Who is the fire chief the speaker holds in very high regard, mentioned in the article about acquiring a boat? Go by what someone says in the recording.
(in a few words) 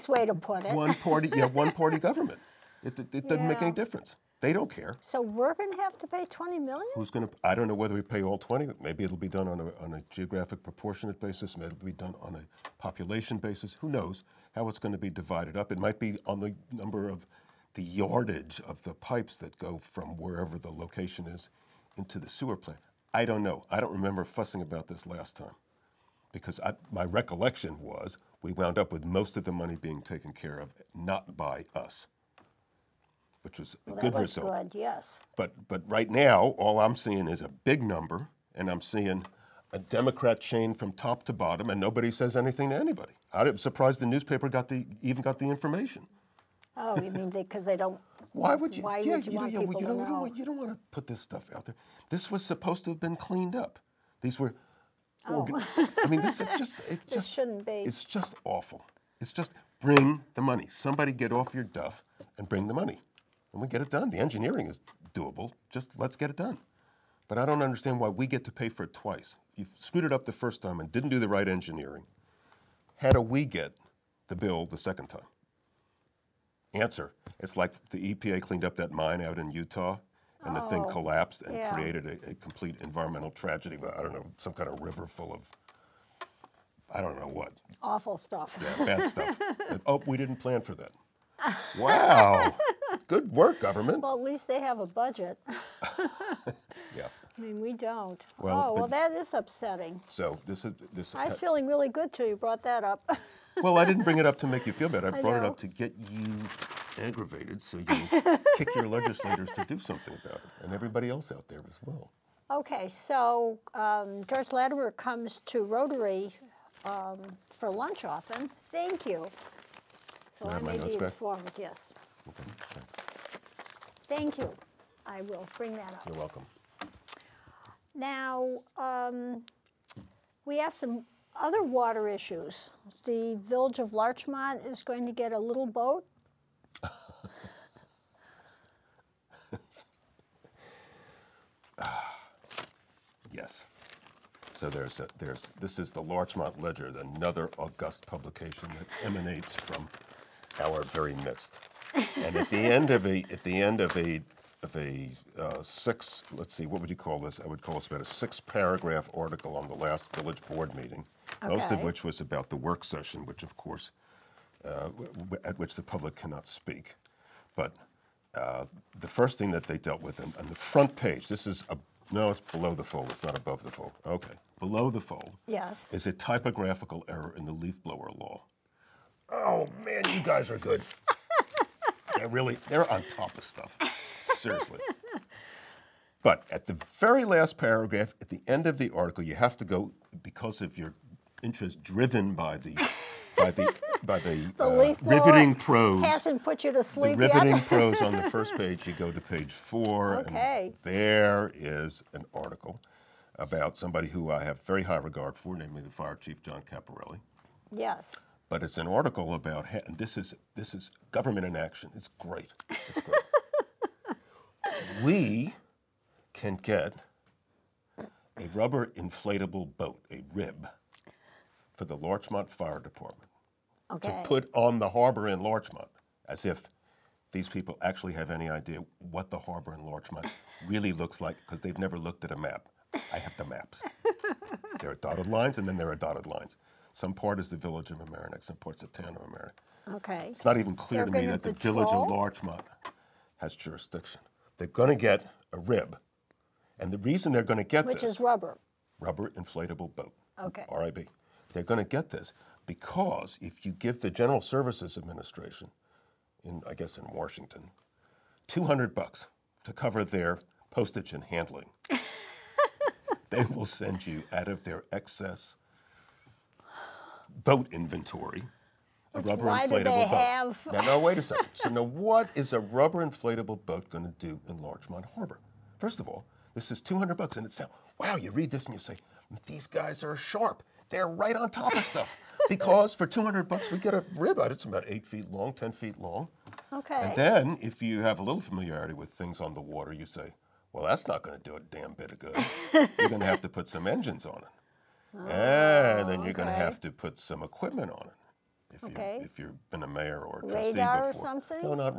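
John Caparelli.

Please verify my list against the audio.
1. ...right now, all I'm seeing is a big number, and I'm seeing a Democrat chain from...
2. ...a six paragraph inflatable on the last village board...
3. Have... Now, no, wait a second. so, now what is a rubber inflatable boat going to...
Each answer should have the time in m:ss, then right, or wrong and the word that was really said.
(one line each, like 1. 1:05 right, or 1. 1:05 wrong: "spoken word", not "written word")
1. 0:35 right
2. 2:38 wrong: "article", not "inflatable"
3. 4:30 right.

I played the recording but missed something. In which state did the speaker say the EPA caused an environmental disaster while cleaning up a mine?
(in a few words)
Utah.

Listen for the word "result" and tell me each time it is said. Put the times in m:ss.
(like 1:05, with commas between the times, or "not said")
0:34.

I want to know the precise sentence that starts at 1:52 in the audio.
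Okay, so um, George Latimer comes to Rotary um, for lunch often.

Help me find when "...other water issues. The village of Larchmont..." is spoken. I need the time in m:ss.
2:11.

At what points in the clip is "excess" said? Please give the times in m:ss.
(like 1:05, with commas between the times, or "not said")
4:24.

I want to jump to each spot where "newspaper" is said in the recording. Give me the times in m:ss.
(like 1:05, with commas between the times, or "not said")
0:44.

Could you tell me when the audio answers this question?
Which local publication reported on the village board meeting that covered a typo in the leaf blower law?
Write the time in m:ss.
2:26.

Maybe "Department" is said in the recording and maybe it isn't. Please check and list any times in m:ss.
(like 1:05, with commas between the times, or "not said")
3:42.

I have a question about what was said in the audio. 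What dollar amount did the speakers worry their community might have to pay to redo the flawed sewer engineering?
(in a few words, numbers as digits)
20 million.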